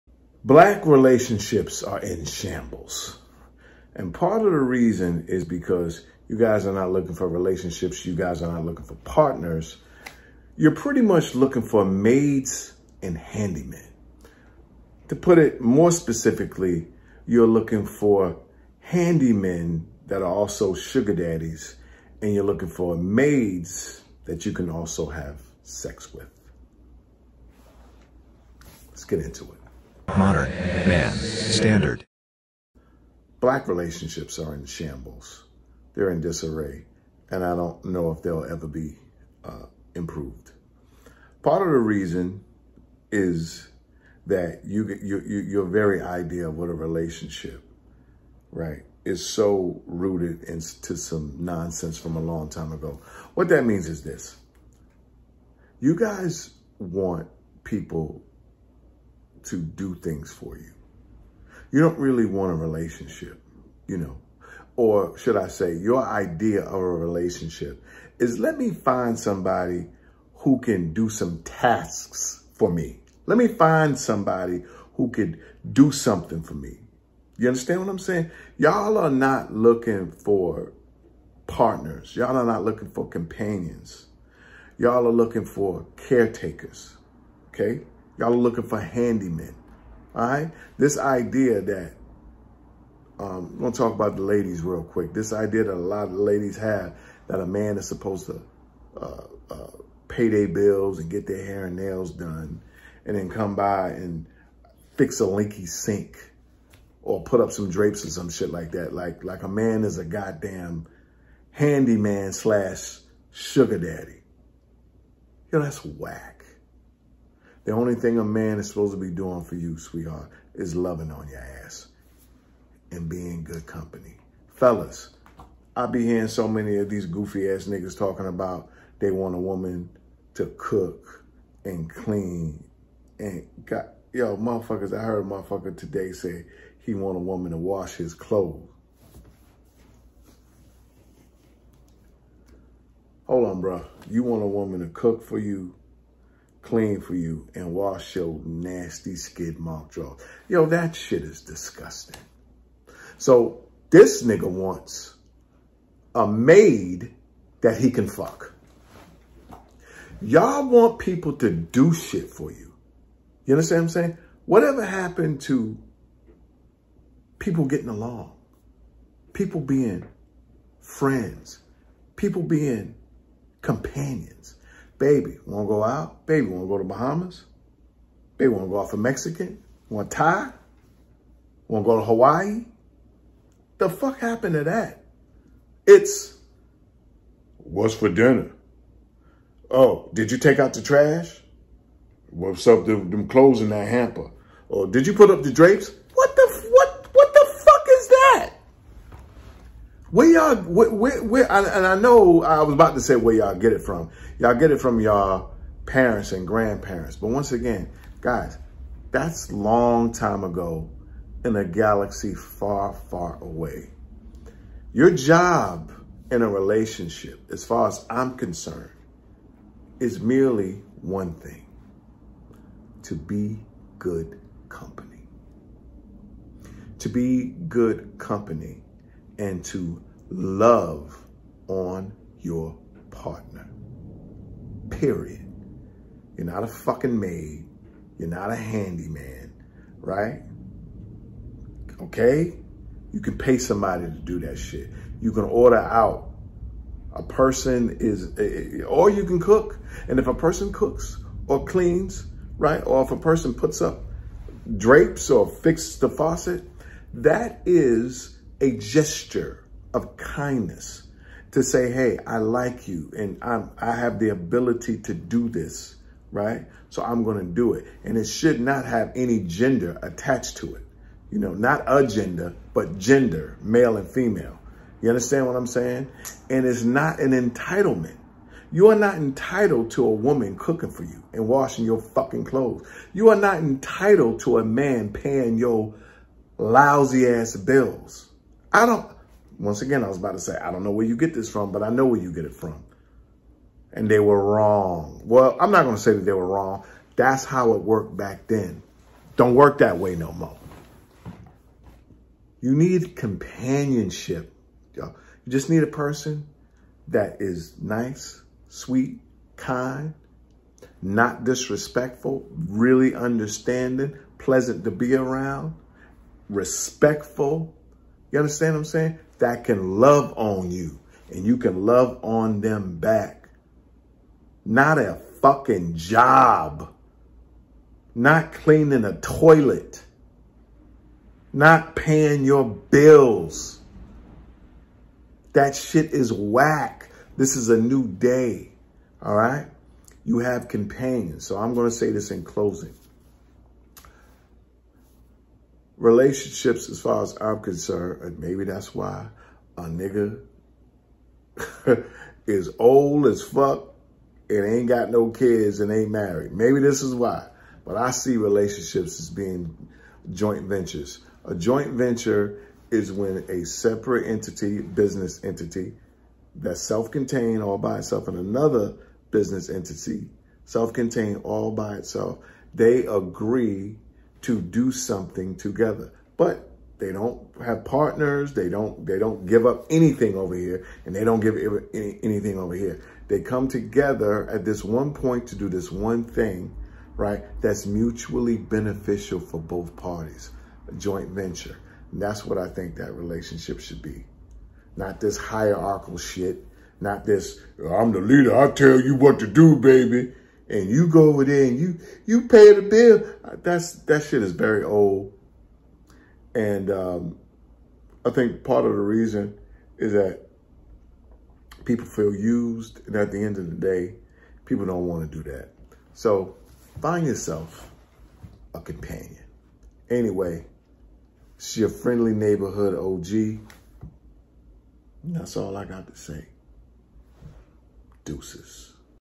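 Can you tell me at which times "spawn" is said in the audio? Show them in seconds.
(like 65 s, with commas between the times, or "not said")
not said.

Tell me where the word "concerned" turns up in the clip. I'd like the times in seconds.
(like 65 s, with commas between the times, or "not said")
218 s, 347 s.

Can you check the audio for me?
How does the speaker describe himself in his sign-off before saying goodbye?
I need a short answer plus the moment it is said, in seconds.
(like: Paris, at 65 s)
friendly neighborhood OG, at 421 s.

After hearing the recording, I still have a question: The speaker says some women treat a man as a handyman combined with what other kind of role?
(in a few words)
sugar daddy.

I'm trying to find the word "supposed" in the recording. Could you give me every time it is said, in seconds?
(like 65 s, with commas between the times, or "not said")
97 s, 118 s.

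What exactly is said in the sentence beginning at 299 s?
Don't work that way no more.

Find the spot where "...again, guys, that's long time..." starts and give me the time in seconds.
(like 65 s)
207 s.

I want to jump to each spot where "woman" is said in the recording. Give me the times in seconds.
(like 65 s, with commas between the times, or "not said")
129 s, 137 s, 144 s, 280 s.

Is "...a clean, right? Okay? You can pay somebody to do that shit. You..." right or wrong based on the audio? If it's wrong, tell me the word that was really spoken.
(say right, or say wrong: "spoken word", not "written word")
wrong: "handyman", not "clean".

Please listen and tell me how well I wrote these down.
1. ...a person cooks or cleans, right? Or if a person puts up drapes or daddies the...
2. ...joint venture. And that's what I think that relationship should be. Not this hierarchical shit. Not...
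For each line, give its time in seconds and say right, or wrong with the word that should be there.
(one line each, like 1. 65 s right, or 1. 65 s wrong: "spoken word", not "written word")
1. 250 s wrong: "fixes", not "daddies"
2. 390 s right.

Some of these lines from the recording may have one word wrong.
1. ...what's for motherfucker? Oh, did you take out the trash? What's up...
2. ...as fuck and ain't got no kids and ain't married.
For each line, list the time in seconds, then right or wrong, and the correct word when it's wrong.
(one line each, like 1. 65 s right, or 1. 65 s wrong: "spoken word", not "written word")
1. 187 s wrong: "dinner", not "motherfucker"
2. 353 s right.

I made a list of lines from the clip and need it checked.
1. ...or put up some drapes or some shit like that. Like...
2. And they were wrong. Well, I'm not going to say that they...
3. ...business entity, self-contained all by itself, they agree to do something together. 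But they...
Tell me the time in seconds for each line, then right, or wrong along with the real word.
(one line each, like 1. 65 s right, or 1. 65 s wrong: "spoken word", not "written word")
1. 107 s right
2. 293 s right
3. 369 s right.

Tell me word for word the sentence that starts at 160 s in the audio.
Y'all want people to do shit for you.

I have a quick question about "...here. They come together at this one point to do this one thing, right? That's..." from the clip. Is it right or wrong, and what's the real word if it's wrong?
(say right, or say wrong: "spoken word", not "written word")
right.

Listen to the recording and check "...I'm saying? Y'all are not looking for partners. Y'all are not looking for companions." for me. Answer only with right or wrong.
right.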